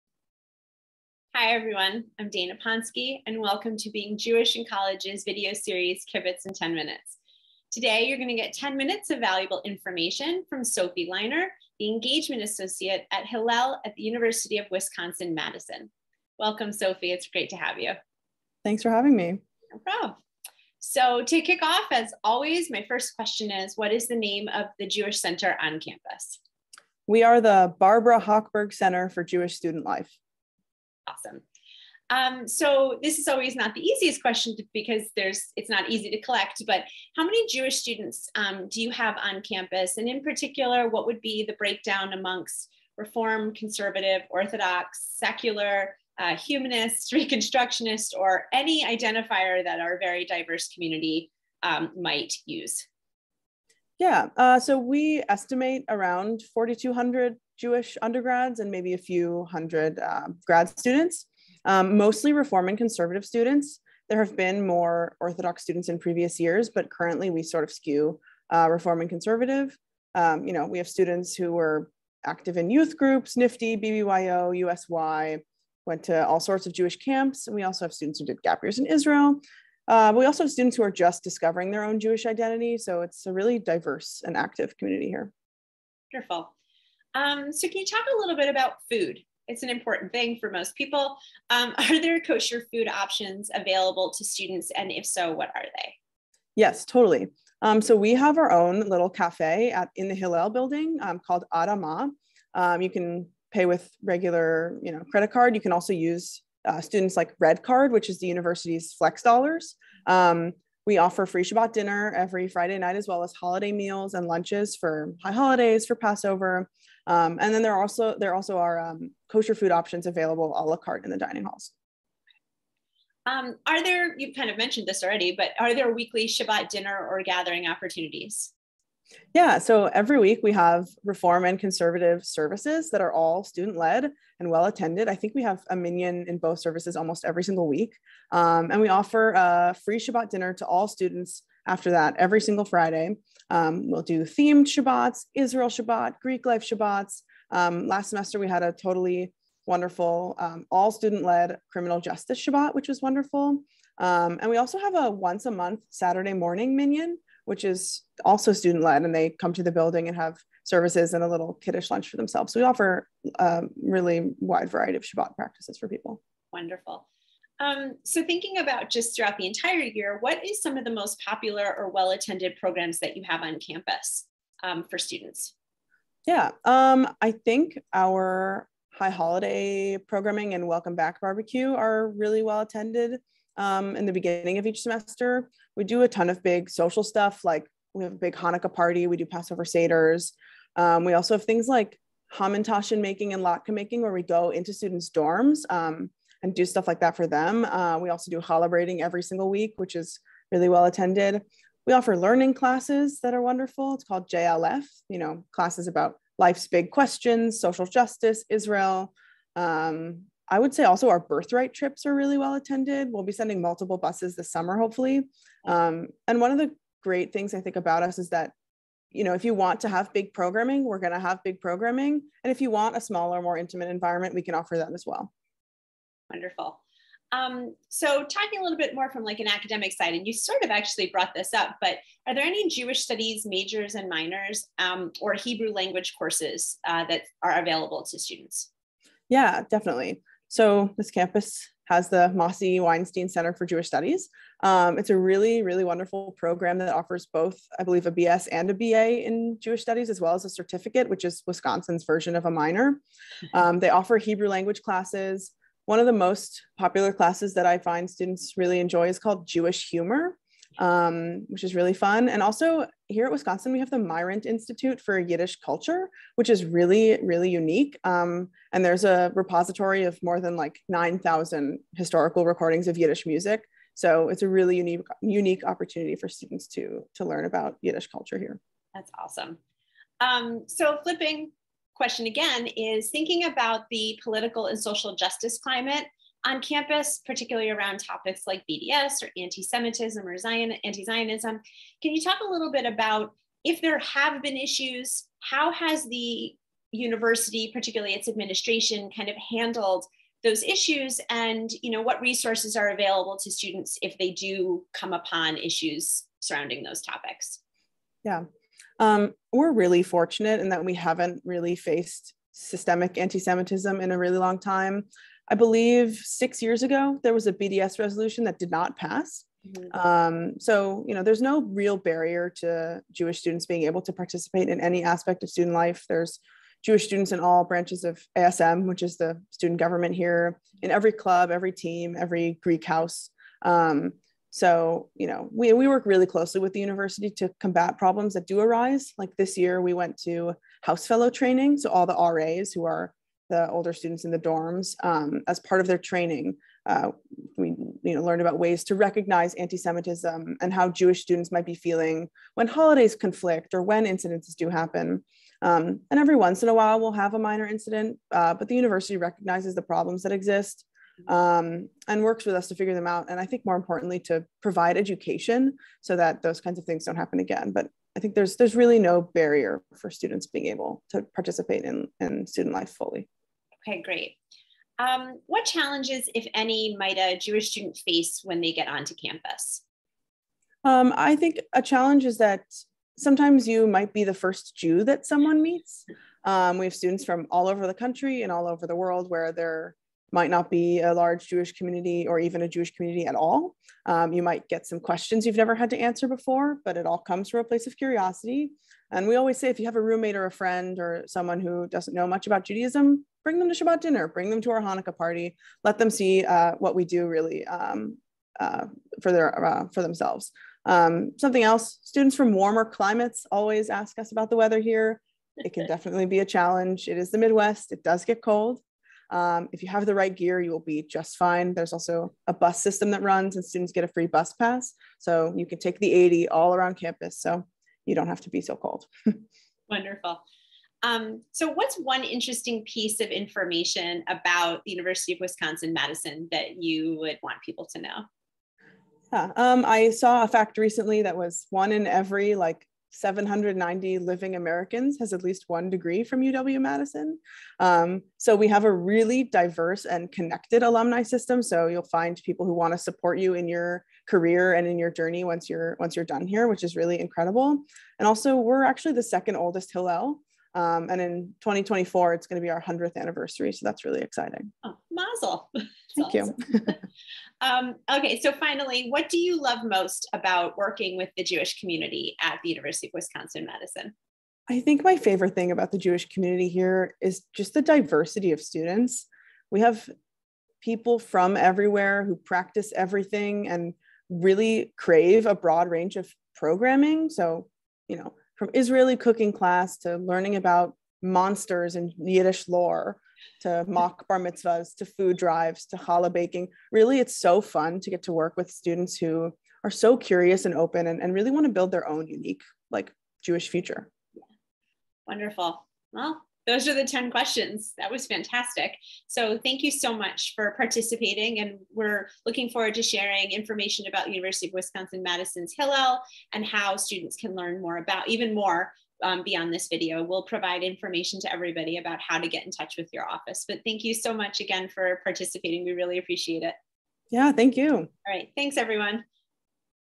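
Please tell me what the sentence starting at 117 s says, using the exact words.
Um, and then there are also there also are um, kosher food options available a la carte in the dining halls.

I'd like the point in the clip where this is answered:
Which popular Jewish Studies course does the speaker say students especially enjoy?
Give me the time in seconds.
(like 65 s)
259 s.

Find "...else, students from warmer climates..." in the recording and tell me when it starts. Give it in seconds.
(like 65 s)
411 s.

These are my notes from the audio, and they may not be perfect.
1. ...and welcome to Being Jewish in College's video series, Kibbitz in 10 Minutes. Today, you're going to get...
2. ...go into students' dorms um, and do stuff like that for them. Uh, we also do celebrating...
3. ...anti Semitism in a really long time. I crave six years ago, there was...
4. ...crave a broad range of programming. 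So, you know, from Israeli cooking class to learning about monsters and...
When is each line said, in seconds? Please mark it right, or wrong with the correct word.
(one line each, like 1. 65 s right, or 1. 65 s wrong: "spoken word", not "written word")
1. 3 s right
2. 194 s right
3. 313 s wrong: "believe", not "crave"
4. 484 s right.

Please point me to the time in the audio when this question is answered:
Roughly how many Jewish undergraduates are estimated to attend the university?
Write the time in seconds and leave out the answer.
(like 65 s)
56 s.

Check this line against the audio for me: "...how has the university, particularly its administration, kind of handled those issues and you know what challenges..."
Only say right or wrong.
wrong.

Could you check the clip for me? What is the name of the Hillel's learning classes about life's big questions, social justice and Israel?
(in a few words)
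JLF.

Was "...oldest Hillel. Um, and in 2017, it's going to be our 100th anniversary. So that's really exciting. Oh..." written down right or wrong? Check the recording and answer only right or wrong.
wrong.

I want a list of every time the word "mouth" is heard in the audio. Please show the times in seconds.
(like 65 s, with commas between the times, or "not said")
not said.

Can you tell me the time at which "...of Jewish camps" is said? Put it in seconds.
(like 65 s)
76 s.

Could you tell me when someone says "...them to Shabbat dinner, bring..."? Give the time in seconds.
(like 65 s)
403 s.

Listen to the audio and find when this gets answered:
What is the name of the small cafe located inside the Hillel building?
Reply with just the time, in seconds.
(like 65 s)
101 s.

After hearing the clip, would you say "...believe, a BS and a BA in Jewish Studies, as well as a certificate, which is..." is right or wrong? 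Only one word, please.
right.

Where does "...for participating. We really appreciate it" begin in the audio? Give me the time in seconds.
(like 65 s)
524 s.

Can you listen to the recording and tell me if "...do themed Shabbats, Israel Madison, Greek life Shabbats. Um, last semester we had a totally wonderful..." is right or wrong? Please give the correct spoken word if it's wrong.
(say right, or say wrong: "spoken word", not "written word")
wrong: "Shabbat", not "Madison".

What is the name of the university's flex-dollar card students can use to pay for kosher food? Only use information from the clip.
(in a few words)
Red Card.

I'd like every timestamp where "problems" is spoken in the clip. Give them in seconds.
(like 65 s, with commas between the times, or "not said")
19 s, 337 s, 359 s.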